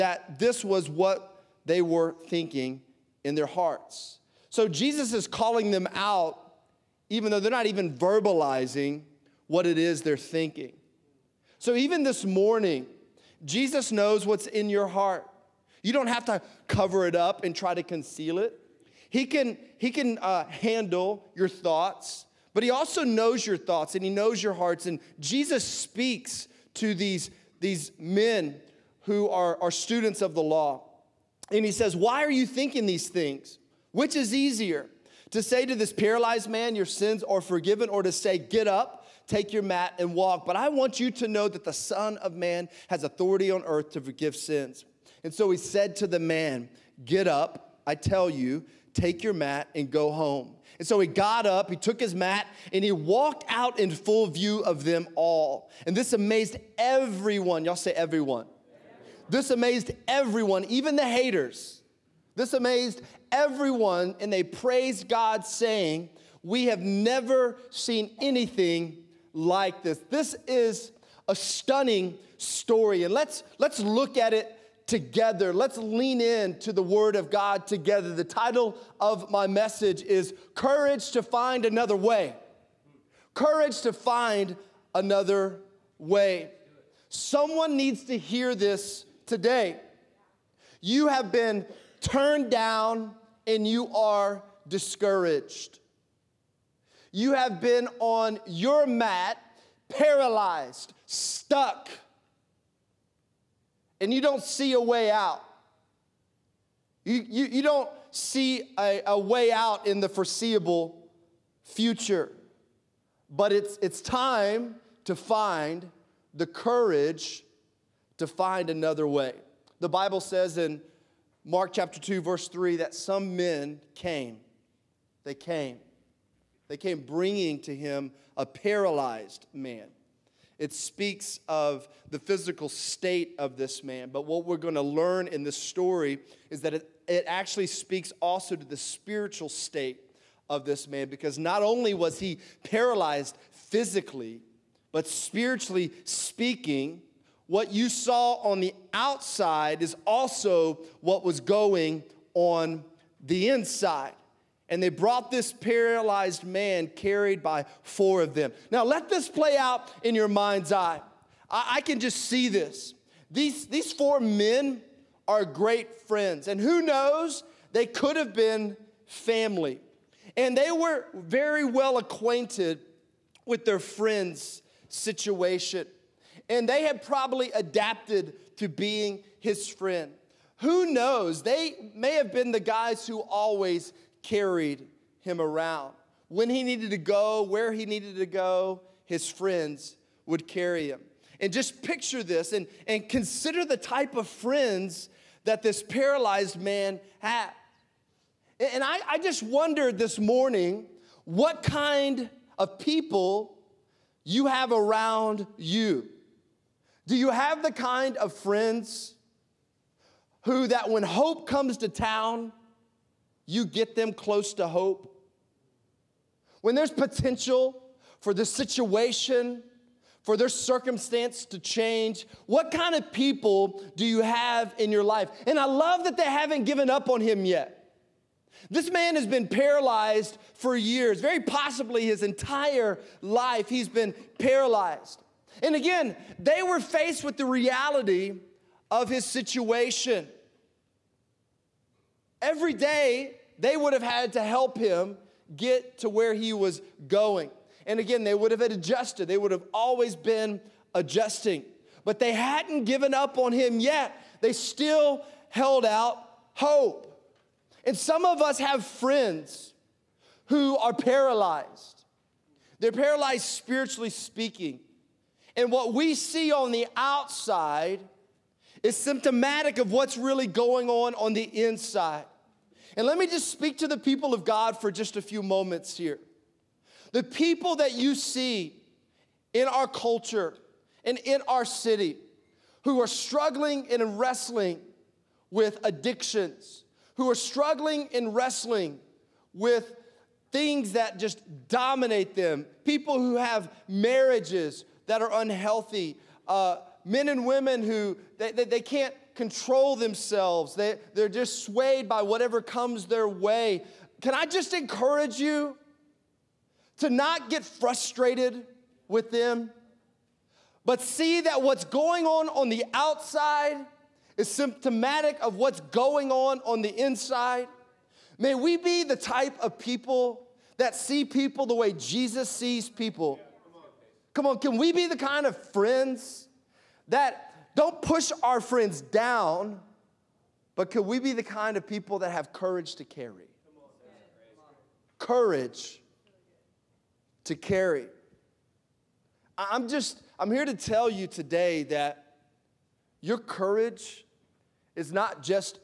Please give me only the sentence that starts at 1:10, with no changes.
This is a stunning story, and let's, let's look at it together.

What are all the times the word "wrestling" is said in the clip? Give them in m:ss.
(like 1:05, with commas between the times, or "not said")
4:44, 4:48.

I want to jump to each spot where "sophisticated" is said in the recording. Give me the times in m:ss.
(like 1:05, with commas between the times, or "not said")
not said.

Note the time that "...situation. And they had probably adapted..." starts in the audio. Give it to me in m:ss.
2:54.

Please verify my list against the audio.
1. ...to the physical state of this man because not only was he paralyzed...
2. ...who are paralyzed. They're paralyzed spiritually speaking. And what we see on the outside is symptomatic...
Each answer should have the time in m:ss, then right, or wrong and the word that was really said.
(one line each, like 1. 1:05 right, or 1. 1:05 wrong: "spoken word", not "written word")
1. 2:18 wrong: "spiritual", not "physical"
2. 4:20 right.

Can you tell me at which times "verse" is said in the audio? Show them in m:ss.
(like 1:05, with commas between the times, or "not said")
2:02.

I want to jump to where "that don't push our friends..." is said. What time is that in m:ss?
5:27.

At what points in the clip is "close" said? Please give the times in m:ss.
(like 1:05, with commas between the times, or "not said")
3:34.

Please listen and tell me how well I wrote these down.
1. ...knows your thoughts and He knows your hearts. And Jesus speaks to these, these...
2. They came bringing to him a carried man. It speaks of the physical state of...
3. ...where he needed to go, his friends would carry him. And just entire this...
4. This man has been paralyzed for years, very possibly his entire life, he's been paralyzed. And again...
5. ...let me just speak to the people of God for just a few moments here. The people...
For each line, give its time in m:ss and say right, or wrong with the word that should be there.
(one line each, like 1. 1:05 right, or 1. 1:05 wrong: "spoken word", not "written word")
1. 0:23 right
2. 2:06 wrong: "paralyzed", not "carried"
3. 3:07 wrong: "picture", not "entire"
4. 3:48 right
5. 4:33 right.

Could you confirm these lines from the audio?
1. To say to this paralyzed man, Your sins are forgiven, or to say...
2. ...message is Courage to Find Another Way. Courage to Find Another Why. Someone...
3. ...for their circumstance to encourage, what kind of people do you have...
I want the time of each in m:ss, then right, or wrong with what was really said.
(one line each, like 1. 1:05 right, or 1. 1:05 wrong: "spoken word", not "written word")
1. 0:35 right
2. 1:19 wrong: "Way", not "Why"
3. 3:40 wrong: "change", not "encourage".